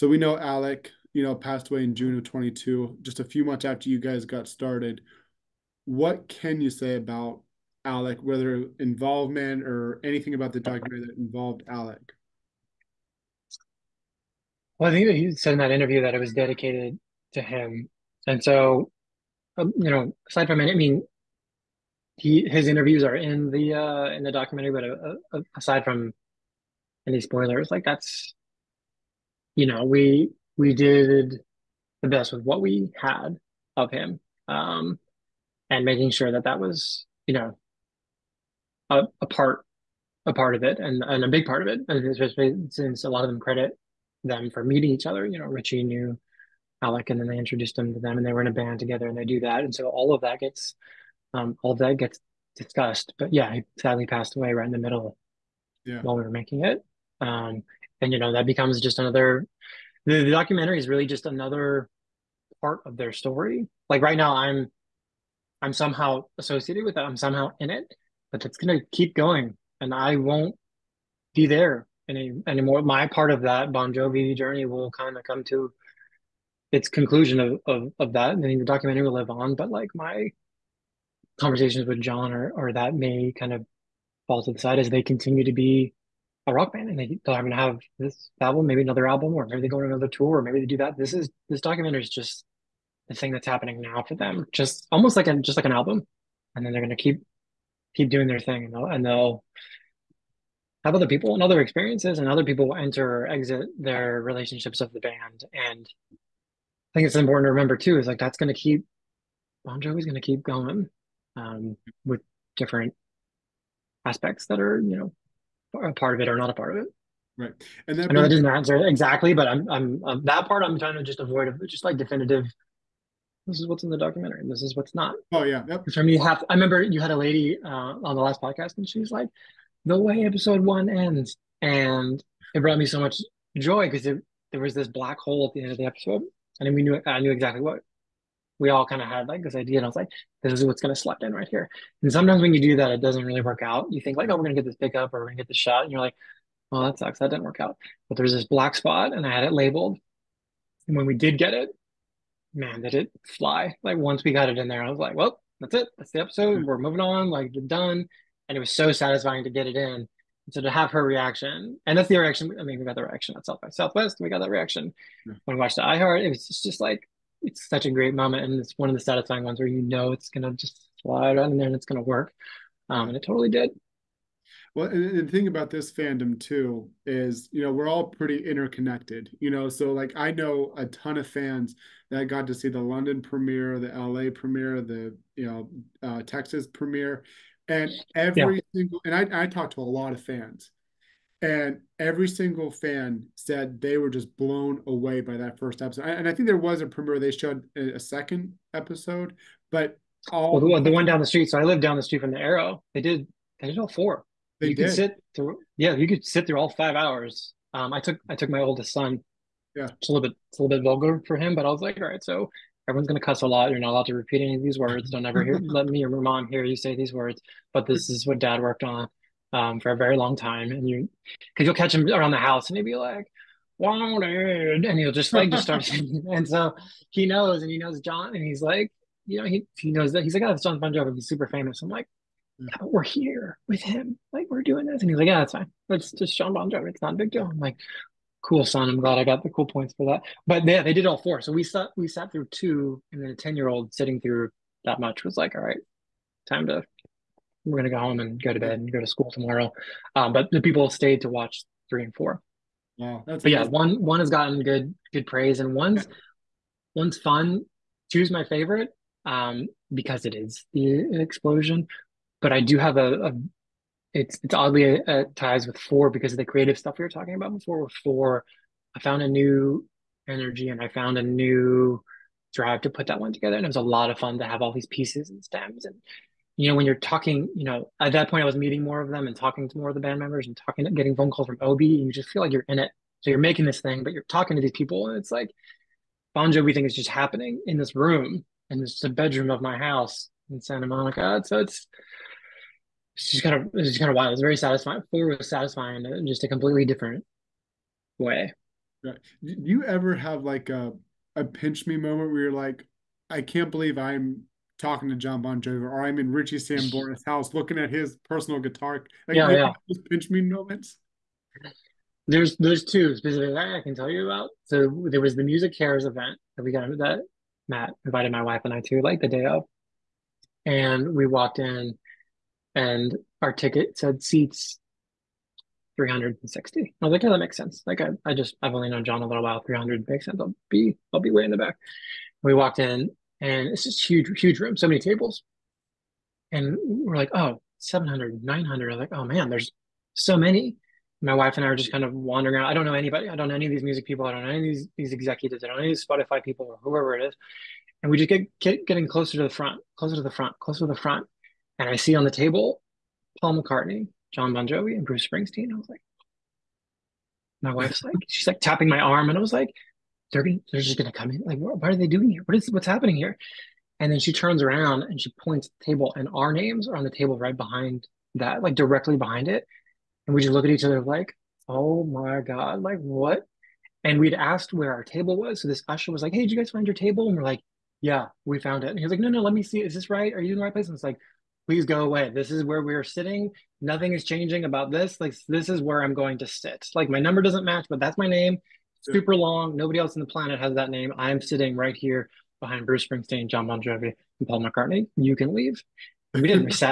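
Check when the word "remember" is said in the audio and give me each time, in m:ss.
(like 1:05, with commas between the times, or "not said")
1:47, 2:06.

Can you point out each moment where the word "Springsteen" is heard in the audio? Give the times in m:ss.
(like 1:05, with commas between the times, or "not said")
5:55, 6:33.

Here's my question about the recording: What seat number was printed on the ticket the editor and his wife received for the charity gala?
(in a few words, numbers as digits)
360.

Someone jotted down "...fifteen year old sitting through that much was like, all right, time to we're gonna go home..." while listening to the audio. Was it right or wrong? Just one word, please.
wrong.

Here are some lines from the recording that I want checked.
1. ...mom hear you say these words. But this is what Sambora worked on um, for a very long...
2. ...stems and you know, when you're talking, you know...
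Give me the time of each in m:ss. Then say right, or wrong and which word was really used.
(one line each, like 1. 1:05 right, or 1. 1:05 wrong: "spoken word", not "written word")
1. 3:36 wrong: "Dad", not "Sambora"
2. 4:35 right.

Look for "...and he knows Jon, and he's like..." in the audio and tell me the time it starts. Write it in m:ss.
3:47.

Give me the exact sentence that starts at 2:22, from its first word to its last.
And sometimes when you do that, it doesn't really work out.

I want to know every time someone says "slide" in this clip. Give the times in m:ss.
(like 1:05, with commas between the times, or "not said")
2:51.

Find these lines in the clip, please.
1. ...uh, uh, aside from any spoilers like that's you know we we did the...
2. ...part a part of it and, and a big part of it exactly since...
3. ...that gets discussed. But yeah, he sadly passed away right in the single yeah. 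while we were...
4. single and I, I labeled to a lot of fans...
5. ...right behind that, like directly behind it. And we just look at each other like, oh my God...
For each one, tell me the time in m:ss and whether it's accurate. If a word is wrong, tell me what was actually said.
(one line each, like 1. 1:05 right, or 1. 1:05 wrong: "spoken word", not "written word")
1. 0:24 right
2. 0:39 wrong: "especially", not "exactly"
3. 0:51 wrong: "middle", not "single"
4. 3:08 wrong: "talked", not "labeled"
5. 6:07 right.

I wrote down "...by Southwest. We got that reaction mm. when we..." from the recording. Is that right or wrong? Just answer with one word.
right.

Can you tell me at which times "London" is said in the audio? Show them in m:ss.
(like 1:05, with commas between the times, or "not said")
3:02.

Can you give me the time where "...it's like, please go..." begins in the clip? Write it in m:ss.
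6:20.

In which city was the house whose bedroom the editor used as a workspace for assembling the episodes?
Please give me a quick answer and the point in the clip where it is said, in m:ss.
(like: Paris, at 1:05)
Santa Monica, at 4:50.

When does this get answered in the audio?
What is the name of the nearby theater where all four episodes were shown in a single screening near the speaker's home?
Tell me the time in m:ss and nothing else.
3:22.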